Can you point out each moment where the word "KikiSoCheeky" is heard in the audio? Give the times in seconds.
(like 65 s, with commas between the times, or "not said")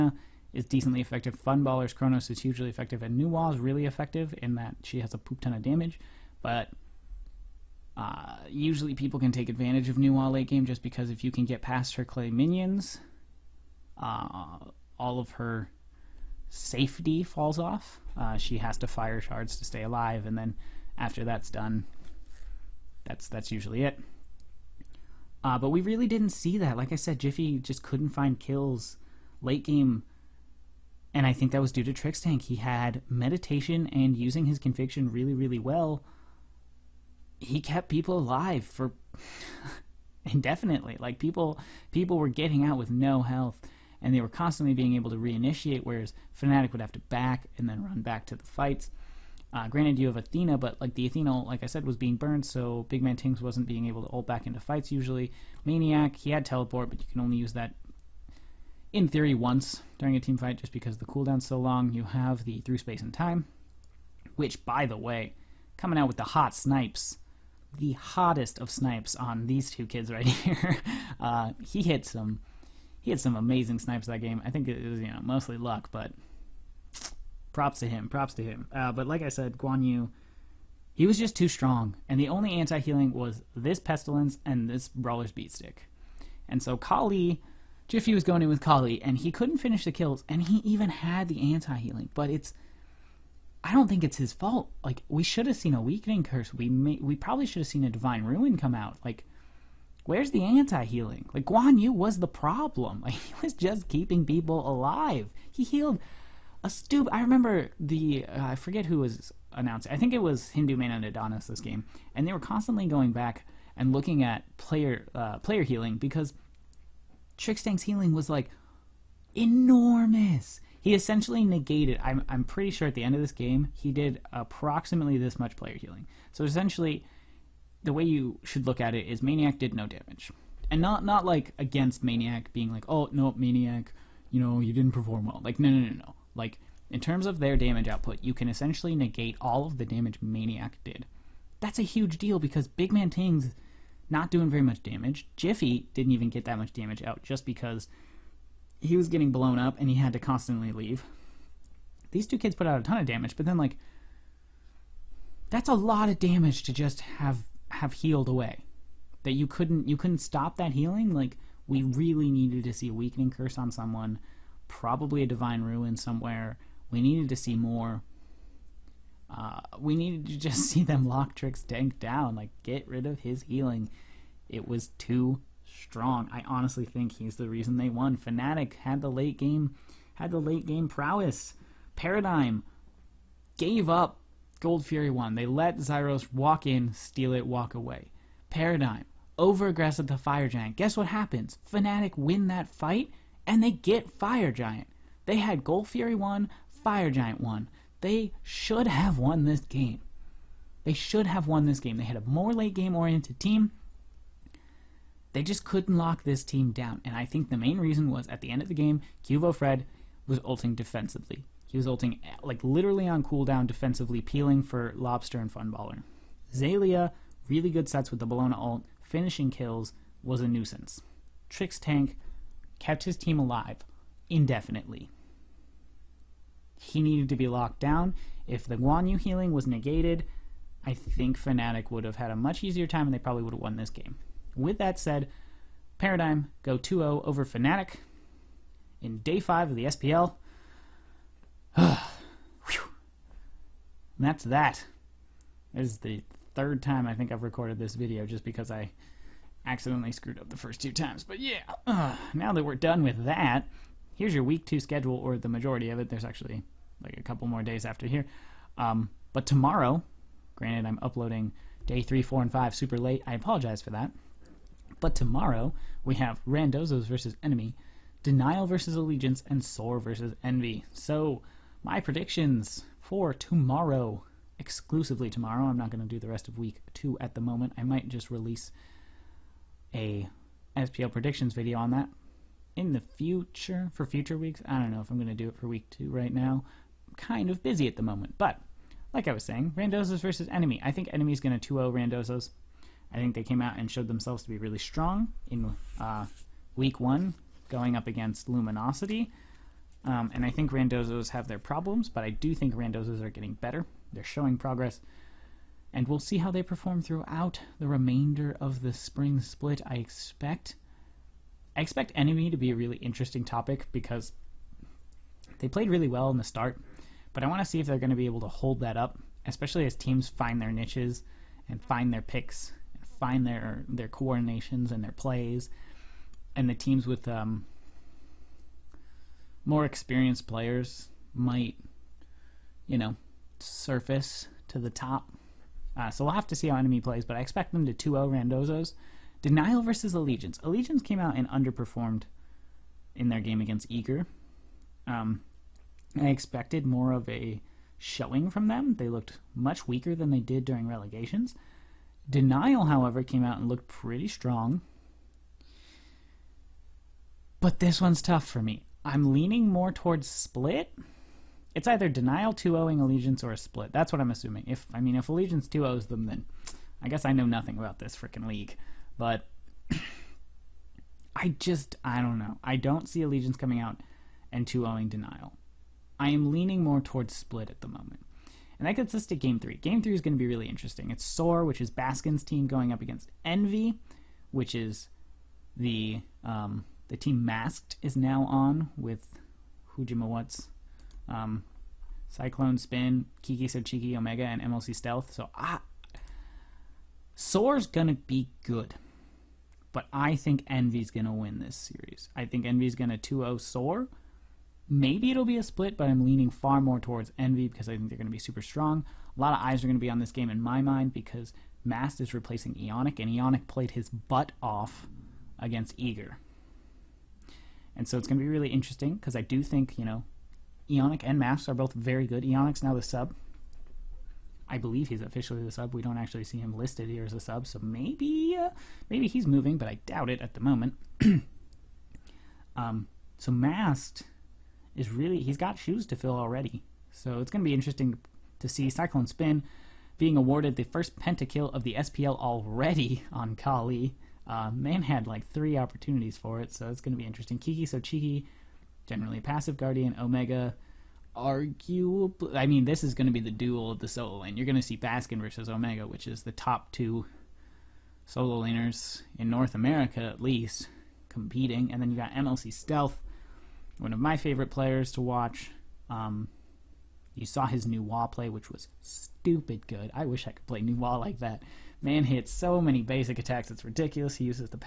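393 s, 447 s.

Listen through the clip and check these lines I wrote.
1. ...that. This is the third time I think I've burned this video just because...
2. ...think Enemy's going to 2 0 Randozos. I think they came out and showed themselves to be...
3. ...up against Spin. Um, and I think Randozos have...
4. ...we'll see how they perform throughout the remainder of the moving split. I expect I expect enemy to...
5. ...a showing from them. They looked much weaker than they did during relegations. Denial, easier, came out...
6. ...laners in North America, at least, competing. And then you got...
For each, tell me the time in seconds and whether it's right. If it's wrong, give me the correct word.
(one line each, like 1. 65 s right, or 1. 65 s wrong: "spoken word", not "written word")
1. 244 s wrong: "recorded", not "burned"
2. 290 s right
3. 297 s wrong: "Luminosity", not "Spin"
4. 306 s wrong: "spring", not "moving"
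5. 347 s wrong: "however", not "easier"
6. 458 s right.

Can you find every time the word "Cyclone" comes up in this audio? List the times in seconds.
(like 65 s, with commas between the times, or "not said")
392 s, 438 s.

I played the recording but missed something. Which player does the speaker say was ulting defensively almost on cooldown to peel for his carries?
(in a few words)
Cubo Fred.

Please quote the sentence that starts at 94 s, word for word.
Like we should have seen a weakening curse.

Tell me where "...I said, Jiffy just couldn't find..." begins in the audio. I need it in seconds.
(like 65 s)
26 s.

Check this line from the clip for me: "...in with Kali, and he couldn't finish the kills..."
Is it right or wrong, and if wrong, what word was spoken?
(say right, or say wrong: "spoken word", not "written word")
right.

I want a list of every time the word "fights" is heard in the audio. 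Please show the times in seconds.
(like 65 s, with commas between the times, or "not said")
48 s, 54 s, 60 s, 192 s.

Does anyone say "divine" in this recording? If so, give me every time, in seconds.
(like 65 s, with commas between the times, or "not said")
97 s, 165 s.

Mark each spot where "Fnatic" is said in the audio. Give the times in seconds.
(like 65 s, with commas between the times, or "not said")
46 s, 178 s, 191 s, 231 s, 237 s.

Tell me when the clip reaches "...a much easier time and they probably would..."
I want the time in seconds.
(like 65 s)
232 s.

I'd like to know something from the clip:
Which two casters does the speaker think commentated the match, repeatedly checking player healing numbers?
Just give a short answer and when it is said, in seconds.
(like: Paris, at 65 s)
Hindu Man and Adonis, at 110 s.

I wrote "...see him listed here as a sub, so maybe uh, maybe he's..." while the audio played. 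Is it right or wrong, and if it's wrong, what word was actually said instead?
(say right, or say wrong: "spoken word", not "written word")
right.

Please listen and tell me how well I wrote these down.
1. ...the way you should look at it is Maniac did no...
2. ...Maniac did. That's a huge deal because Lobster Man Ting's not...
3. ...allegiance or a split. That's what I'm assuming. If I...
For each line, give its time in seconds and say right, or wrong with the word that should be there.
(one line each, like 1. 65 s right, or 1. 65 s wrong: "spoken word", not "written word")
1. 127 s right
2. 140 s wrong: "Big", not "Lobster"
3. 362 s right.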